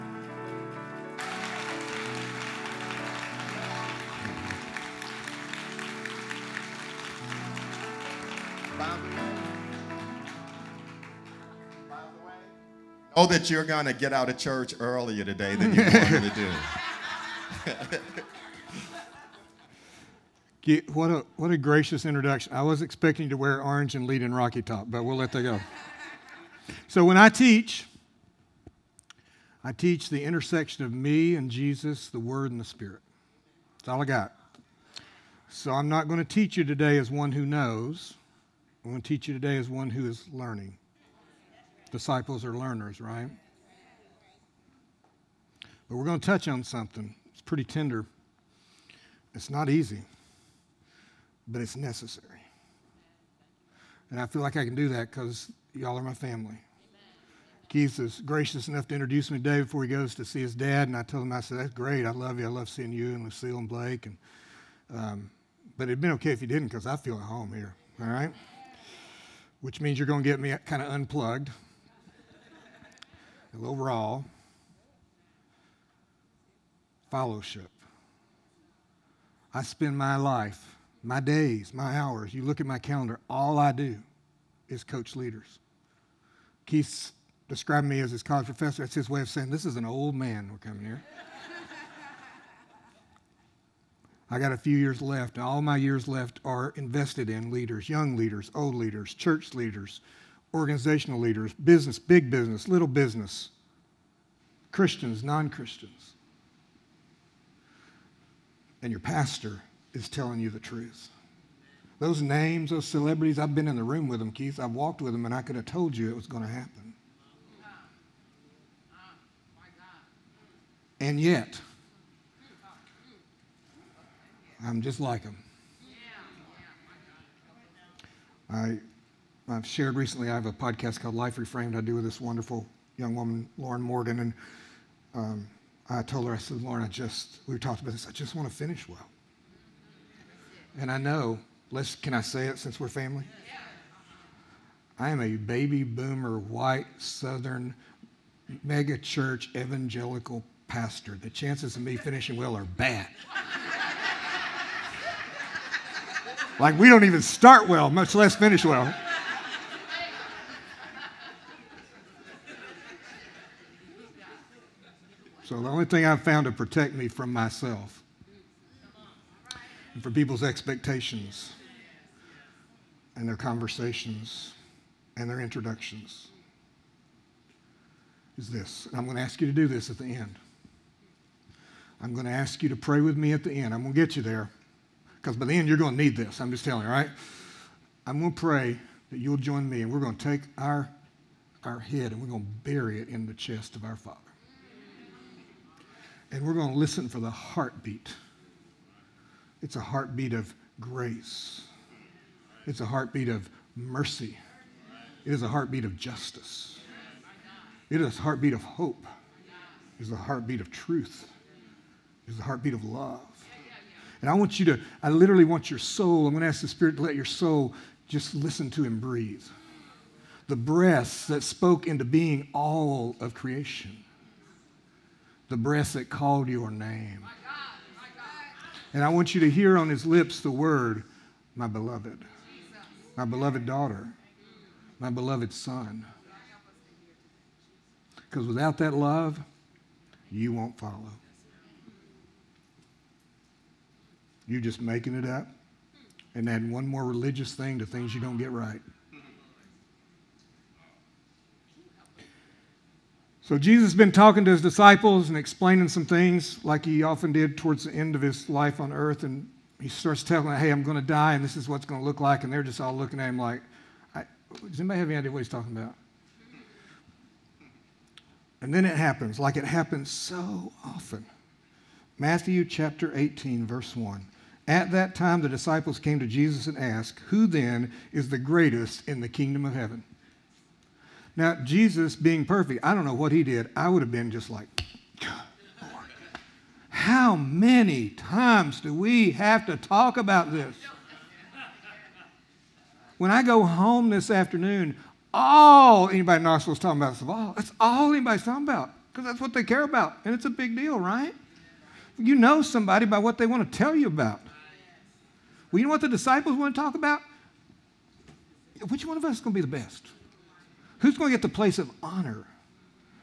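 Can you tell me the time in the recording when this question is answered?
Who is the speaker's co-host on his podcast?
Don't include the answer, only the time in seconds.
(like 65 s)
133 s.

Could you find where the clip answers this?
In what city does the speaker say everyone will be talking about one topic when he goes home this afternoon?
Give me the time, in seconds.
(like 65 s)
296 s.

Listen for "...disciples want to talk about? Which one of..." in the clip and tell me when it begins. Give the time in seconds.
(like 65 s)
306 s.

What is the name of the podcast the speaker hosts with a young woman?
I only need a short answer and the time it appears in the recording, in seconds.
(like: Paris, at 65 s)
Life Reframed, at 131 s.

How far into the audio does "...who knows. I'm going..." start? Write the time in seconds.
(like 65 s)
37 s.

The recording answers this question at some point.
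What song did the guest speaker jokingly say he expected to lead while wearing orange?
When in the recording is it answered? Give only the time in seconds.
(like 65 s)
24 s.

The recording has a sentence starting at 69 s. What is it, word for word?
Which means you're going to get me kind of unplugged, a little raw.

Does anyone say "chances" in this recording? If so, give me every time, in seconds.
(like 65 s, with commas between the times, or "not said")
151 s.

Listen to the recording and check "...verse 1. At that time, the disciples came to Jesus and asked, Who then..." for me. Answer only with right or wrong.
right.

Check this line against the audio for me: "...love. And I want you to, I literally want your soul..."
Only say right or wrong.
right.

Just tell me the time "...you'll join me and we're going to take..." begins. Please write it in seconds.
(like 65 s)
189 s.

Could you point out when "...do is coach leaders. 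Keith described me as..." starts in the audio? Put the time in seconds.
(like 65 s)
83 s.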